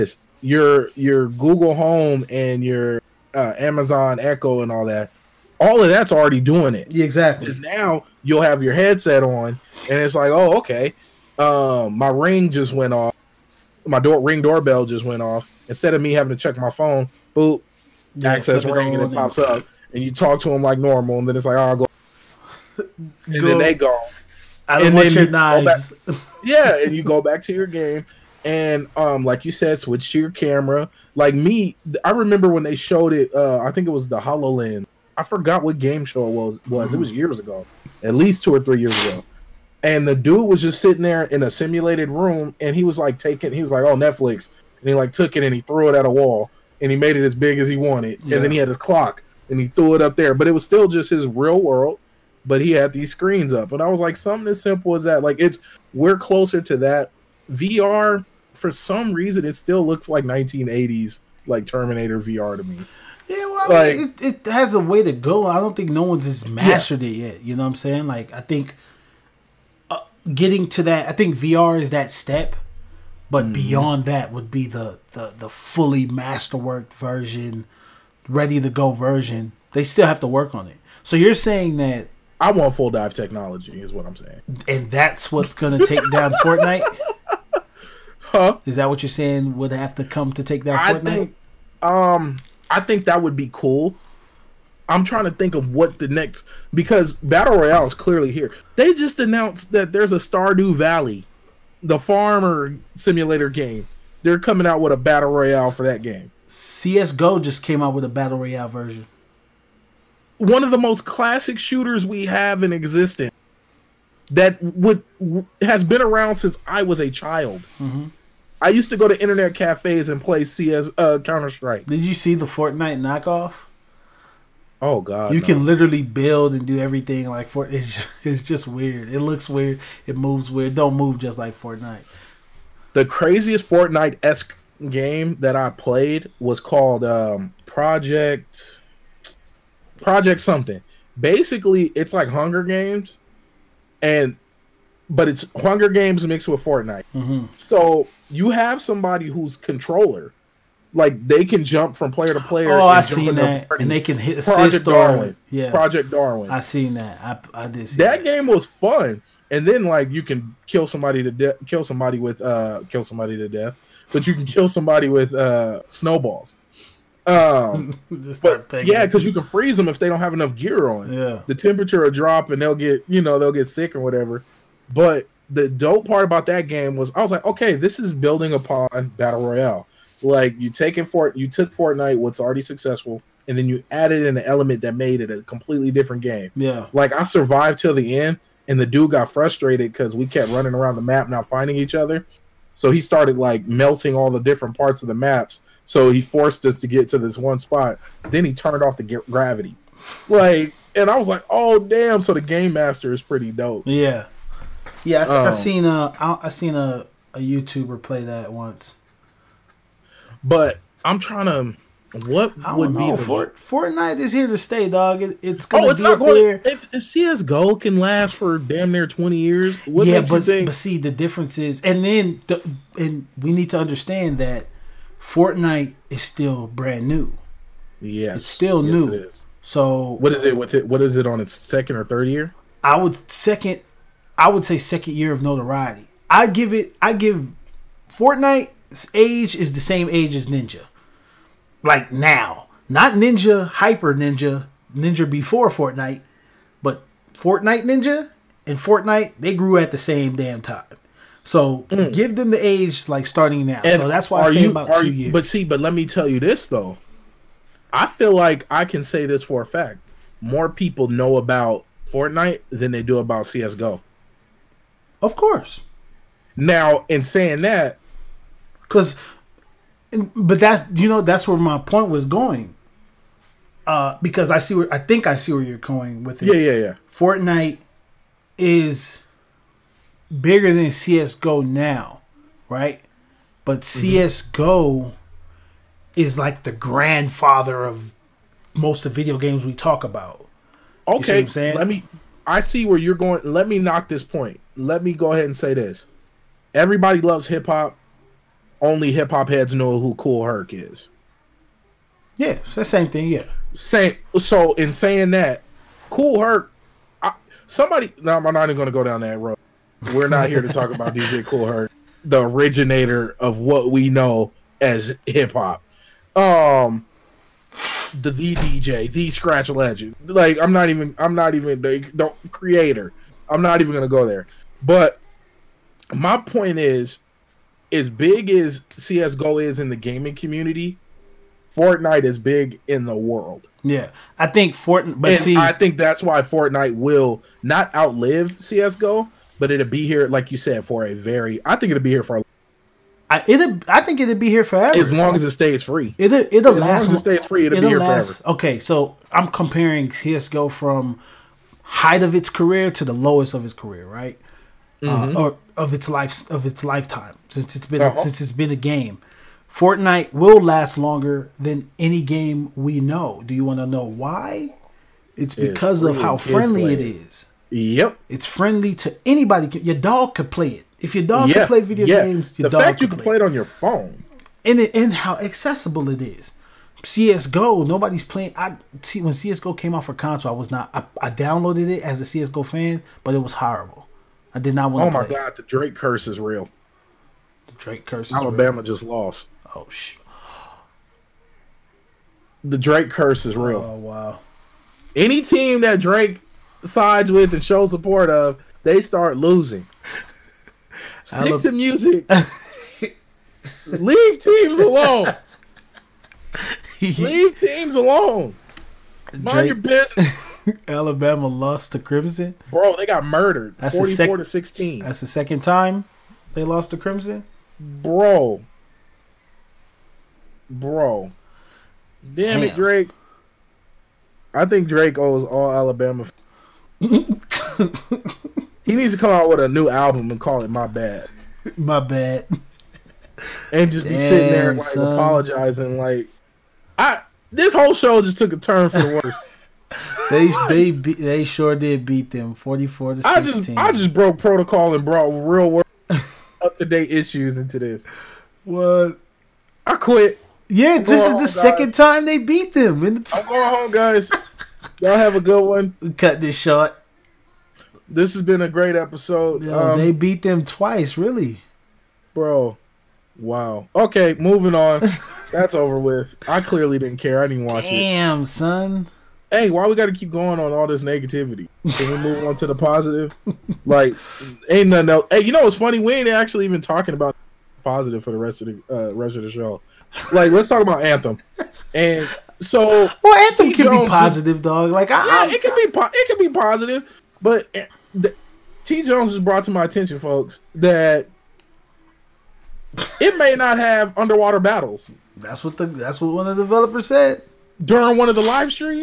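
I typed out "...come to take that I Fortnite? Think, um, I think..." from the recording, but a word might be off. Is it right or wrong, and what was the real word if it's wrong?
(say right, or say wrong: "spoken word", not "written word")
right.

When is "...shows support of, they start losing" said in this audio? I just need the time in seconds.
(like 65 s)
397 s.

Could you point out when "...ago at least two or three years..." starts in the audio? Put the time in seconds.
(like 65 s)
37 s.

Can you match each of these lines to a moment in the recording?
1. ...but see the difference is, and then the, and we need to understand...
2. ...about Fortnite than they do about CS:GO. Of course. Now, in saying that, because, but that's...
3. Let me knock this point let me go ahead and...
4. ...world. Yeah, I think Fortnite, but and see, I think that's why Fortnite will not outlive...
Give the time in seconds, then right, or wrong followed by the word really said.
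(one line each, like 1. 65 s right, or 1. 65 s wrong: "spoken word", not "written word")
1. 220 s right
2. 261 s right
3. 293 s right
4. 333 s right.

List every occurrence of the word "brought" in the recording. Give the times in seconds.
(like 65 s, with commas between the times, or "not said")
445 s, 489 s.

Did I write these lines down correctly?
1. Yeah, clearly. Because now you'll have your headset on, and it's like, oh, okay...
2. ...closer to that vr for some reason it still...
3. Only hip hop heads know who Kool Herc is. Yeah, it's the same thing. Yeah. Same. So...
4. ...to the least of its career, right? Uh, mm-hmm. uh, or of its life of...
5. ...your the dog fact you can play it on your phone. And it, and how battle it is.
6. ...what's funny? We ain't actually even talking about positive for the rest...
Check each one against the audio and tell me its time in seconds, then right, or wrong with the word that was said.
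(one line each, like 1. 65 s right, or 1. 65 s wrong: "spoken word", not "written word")
1. 6 s wrong: "exactly", not "clearly"
2. 56 s right
3. 298 s right
4. 352 s wrong: "lowest", not "least"
5. 372 s wrong: "accessible", not "battle"
6. 475 s right.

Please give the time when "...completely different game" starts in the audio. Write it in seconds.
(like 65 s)
185 s.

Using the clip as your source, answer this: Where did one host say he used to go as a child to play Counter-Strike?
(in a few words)
internet cafes.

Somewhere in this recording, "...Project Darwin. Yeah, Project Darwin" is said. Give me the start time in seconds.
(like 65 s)
154 s.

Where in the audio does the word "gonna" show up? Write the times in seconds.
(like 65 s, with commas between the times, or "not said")
85 s, 215 s.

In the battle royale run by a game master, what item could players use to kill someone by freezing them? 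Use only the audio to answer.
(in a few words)
snowballs.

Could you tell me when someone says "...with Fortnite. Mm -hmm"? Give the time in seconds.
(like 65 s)
146 s.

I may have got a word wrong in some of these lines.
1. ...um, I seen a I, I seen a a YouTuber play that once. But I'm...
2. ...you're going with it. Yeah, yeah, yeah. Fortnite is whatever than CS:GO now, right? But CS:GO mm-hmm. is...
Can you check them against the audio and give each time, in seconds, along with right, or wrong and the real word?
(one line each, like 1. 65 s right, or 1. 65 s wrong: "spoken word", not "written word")
1. 205 s right
2. 275 s wrong: "bigger", not "whatever".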